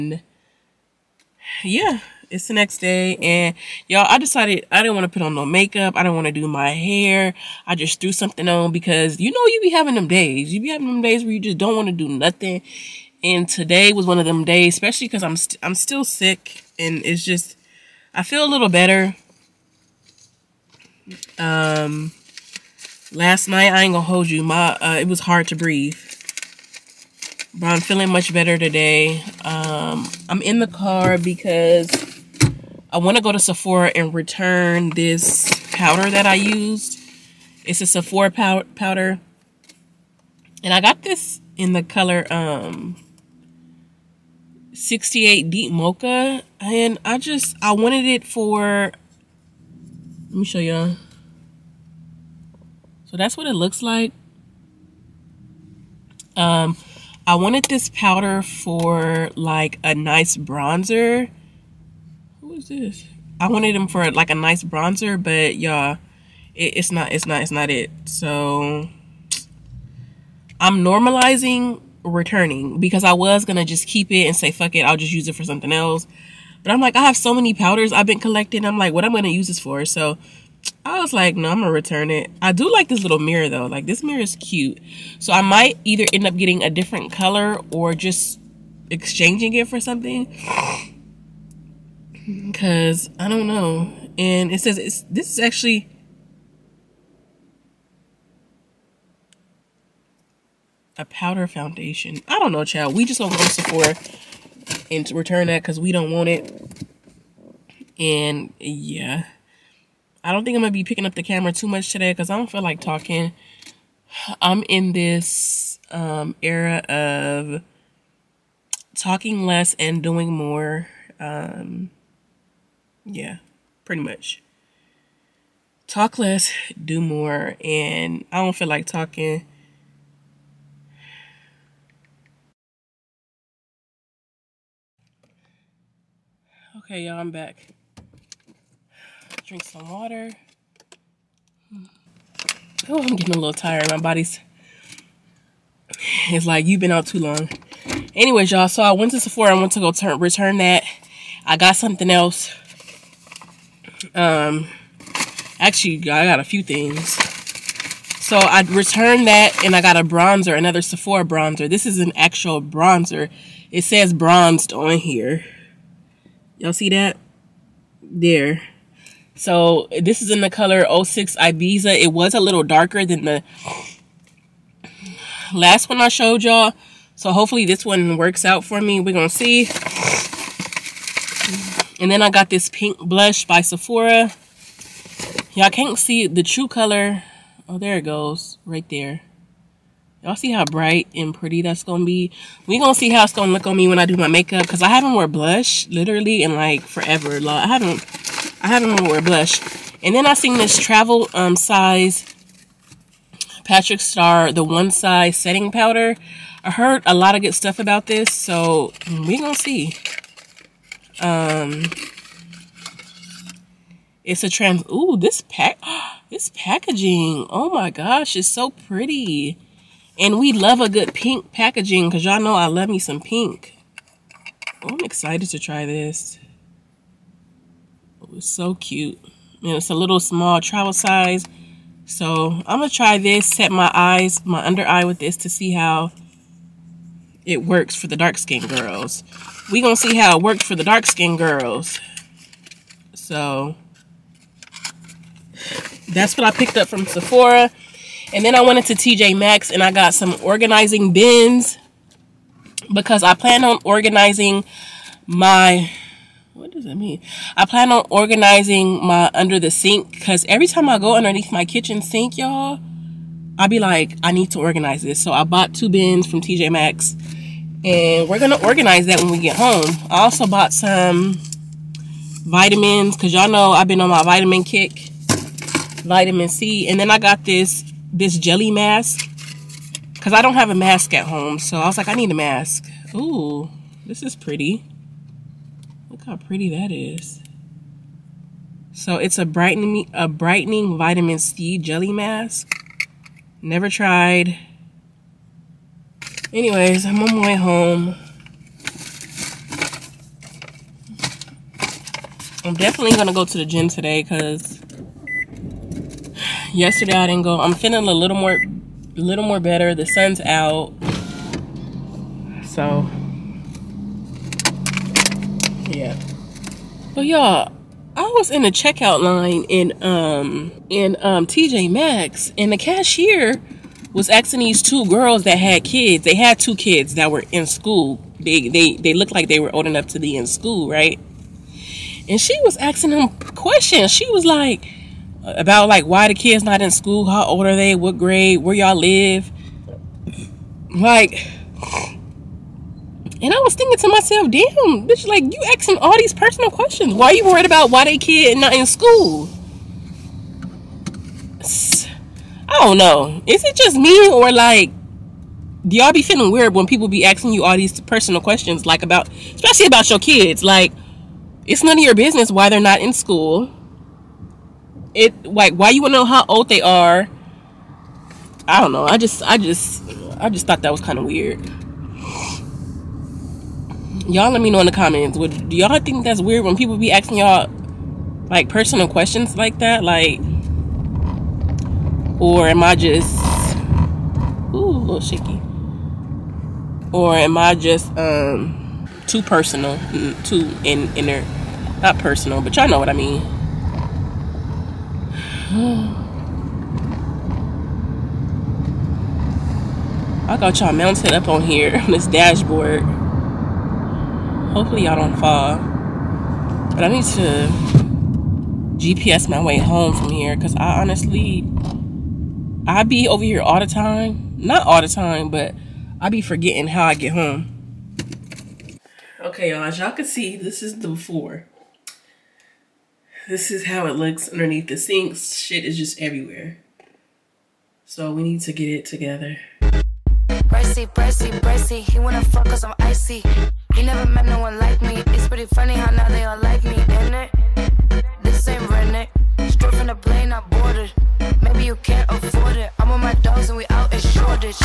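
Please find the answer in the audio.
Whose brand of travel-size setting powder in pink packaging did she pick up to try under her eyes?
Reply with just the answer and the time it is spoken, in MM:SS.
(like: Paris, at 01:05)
Patrick Starrr, at 03:23.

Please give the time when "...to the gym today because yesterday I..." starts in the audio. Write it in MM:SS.
05:03.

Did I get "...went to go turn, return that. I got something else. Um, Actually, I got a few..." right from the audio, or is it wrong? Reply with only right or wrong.
right.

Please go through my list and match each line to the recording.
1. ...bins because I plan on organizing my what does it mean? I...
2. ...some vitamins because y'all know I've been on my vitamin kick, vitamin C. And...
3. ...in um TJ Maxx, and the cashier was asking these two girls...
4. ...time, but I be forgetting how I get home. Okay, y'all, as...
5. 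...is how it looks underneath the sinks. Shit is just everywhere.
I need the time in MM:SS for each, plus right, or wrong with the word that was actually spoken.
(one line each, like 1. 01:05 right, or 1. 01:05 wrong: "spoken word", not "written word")
1. 04:11 right
2. 04:30 right
3. 05:20 right
4. 06:55 right
5. 07:03 right.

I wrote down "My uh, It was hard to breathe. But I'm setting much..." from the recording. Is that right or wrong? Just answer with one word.
wrong.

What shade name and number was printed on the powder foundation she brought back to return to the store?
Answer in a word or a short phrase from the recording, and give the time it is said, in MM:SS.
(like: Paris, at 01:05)
68 deep mocha, at 00:44.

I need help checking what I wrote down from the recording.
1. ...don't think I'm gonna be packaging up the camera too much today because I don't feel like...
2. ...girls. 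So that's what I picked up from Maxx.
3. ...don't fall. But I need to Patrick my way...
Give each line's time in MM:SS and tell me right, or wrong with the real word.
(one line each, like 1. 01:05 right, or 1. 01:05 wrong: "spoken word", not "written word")
1. 01:50 wrong: "picking", not "packaging"
2. 04:01 wrong: "Sephora", not "Maxx"
3. 06:45 wrong: "GPS", not "Patrick".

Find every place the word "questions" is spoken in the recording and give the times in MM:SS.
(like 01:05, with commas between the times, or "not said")
05:33, 05:46, 05:58, 06:19.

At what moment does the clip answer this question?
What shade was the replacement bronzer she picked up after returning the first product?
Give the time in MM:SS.
02:51.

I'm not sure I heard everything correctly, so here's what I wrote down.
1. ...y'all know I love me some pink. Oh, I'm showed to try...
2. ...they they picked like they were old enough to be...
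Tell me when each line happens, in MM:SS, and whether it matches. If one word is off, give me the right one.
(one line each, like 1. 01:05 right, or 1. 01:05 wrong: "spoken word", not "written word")
1. 03:42 wrong: "excited", not "showed"
2. 05:28 wrong: "looked", not "picked".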